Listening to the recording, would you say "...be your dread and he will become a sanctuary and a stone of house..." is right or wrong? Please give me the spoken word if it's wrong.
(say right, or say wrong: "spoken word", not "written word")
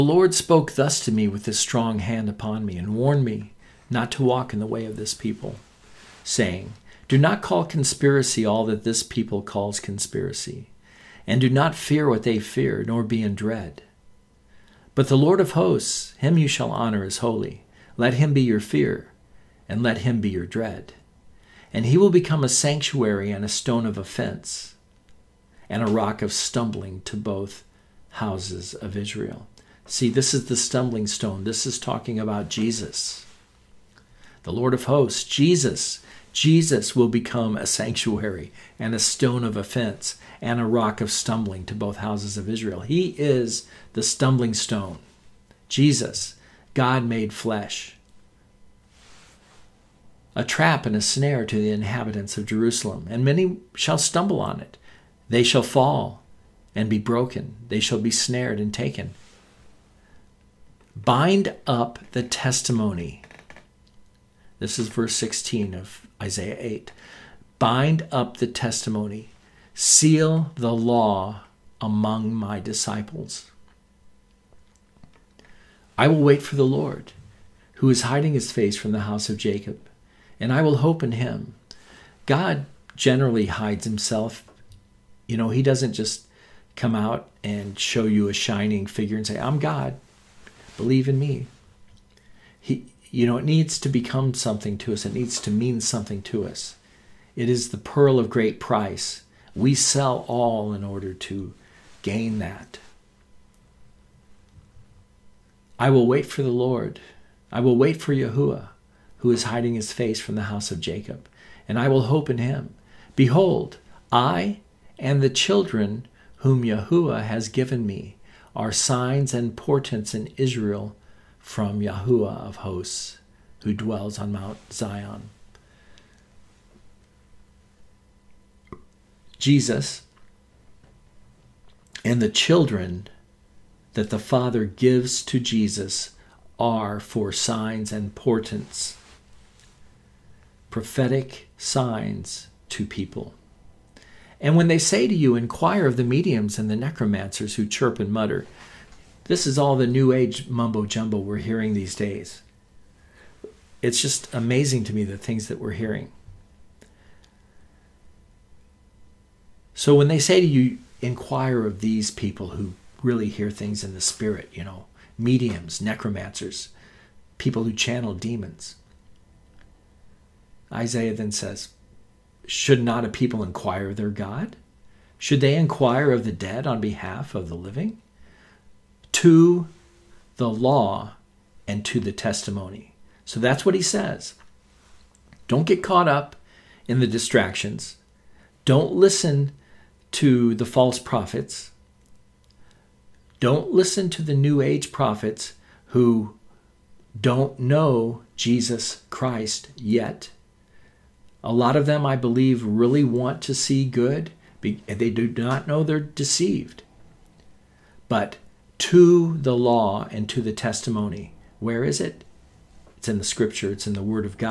wrong: "offense", not "house".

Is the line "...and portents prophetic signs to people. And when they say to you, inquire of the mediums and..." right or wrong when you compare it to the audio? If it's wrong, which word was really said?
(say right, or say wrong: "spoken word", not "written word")
right.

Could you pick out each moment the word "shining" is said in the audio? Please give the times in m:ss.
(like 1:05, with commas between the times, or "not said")
1:28.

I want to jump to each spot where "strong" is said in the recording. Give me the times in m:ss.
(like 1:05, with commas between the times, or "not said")
0:01.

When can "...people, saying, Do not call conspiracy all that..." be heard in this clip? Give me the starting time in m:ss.
0:05.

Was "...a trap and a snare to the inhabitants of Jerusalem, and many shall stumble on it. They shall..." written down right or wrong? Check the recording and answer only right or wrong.
right.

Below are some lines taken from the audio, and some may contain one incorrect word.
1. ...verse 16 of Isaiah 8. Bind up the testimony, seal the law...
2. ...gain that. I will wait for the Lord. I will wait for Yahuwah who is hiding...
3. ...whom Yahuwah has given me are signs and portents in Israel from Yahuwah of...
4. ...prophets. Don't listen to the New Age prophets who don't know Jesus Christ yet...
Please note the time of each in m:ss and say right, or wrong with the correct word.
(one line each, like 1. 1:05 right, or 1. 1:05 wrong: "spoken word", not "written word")
1. 1:04 right
2. 1:42 right
3. 1:56 right
4. 3:10 right.